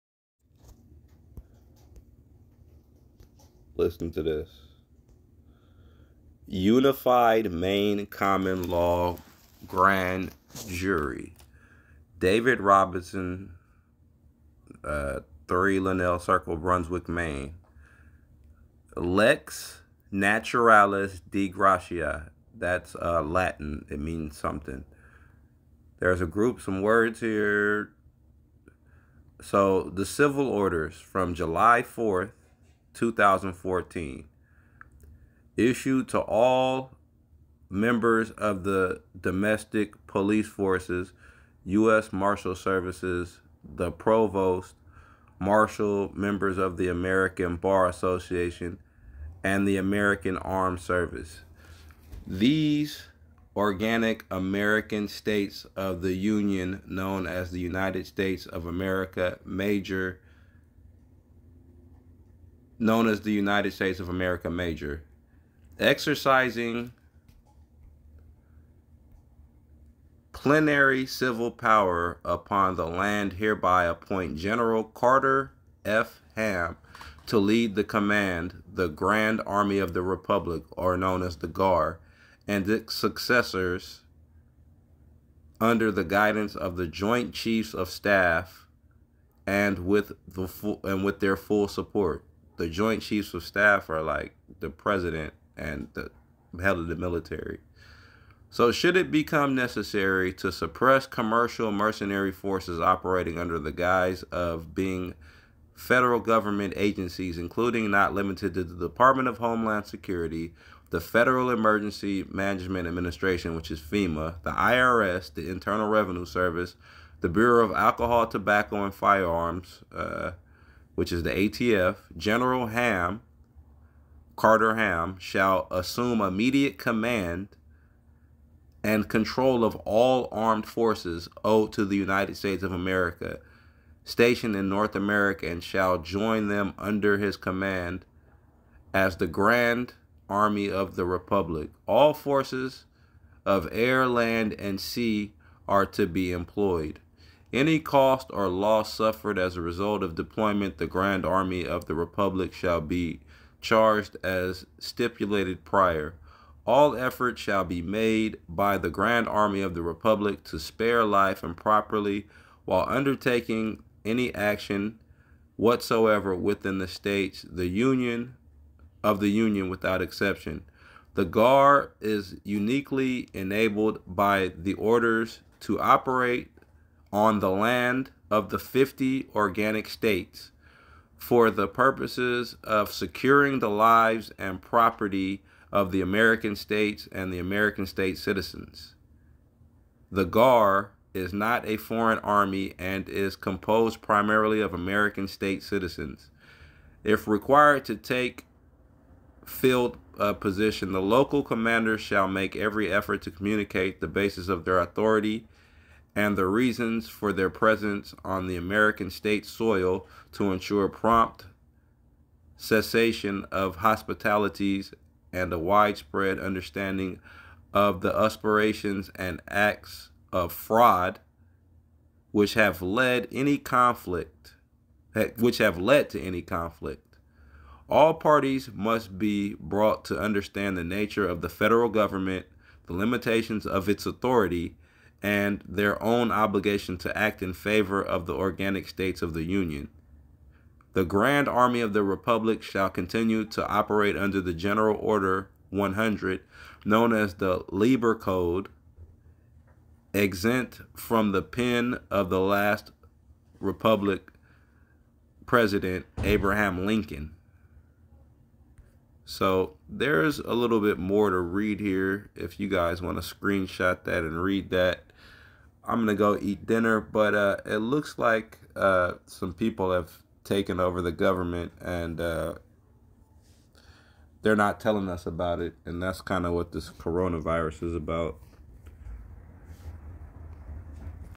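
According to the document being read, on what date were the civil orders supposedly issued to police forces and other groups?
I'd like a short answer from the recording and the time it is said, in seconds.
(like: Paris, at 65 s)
July 4, 2014, at 31 s.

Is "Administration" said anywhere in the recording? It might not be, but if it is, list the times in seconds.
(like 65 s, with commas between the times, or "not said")
112 s.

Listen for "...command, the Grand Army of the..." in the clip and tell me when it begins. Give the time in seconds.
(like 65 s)
77 s.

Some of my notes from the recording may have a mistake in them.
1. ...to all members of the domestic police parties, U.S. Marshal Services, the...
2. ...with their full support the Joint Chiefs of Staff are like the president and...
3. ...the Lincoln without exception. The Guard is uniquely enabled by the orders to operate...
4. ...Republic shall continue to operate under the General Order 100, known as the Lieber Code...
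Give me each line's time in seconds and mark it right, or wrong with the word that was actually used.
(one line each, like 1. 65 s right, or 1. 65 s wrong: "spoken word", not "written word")
1. 36 s wrong: "forces", not "parties"
2. 91 s right
3. 169 s wrong: "Union", not "Lincoln"
4. 242 s right.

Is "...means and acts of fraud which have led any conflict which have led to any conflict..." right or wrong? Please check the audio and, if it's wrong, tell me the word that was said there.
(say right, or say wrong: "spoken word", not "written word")
wrong: "aspirations", not "means".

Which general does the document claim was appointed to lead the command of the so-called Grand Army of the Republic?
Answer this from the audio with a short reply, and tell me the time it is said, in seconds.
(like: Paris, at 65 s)
Carter F. Ham, at 74 s.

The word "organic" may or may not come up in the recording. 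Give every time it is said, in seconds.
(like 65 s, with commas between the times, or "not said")
53 s, 179 s, 238 s.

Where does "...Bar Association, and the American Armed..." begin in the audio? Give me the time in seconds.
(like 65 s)
47 s.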